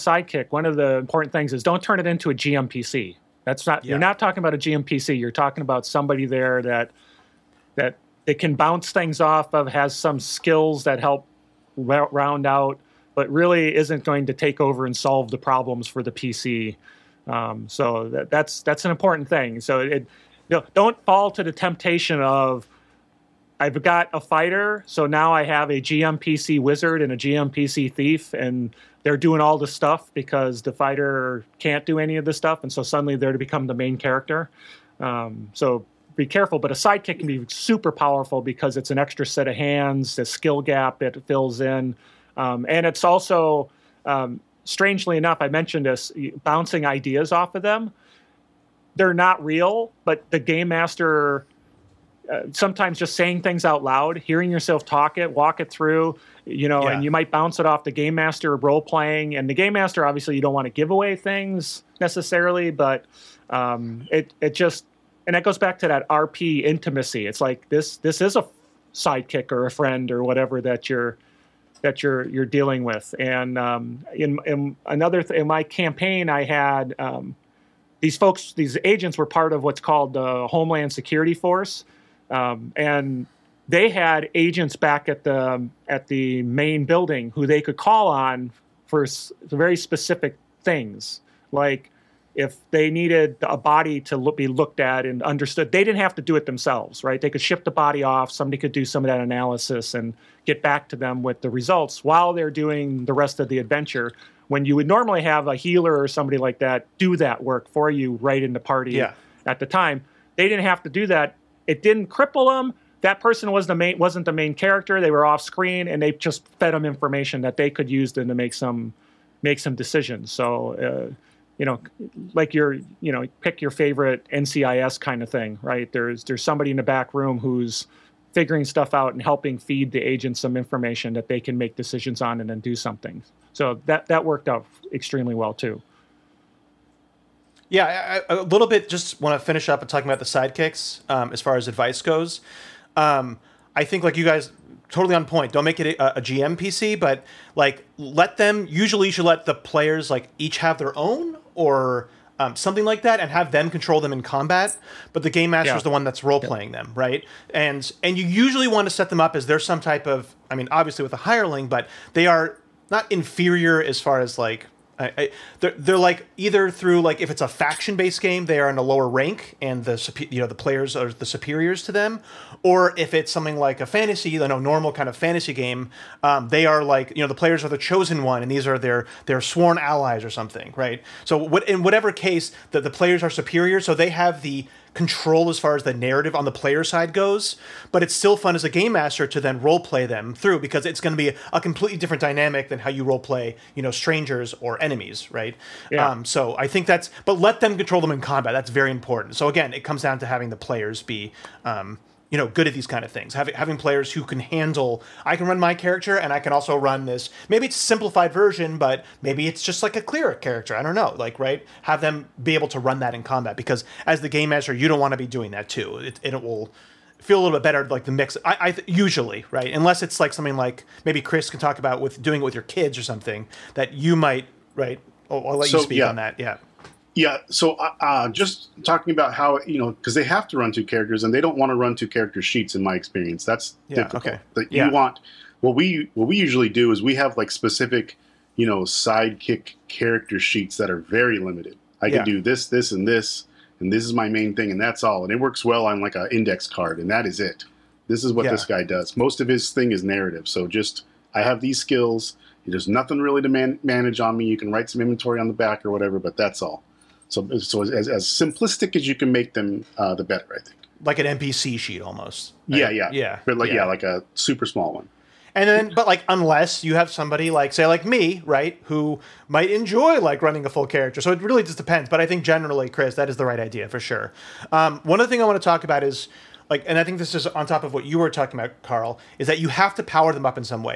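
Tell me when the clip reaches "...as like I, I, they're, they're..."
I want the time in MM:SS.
02:44.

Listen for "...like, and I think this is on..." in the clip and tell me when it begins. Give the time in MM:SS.
04:36.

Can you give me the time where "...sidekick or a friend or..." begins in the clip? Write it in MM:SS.
01:08.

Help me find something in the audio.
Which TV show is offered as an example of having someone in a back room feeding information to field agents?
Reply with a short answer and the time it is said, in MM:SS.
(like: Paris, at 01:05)
NCIS, at 02:04.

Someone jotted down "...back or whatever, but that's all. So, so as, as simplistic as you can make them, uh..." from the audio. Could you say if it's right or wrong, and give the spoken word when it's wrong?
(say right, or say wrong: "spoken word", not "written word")
right.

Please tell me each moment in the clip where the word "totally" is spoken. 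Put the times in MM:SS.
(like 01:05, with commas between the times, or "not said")
02:24.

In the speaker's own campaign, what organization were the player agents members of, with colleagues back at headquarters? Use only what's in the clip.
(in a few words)
Homeland Security Force.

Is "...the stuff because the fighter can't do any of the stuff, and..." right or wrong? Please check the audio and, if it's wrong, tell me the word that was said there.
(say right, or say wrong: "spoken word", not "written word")
right.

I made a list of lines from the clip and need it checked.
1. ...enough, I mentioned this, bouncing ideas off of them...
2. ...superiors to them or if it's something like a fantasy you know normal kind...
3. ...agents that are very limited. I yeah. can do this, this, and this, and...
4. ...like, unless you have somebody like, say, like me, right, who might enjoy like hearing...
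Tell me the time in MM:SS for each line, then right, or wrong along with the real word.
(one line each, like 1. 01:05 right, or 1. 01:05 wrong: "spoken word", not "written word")
1. 00:45 right
2. 02:51 right
3. 04:00 wrong: "sheets", not "agents"
4. 04:26 wrong: "running", not "hearing".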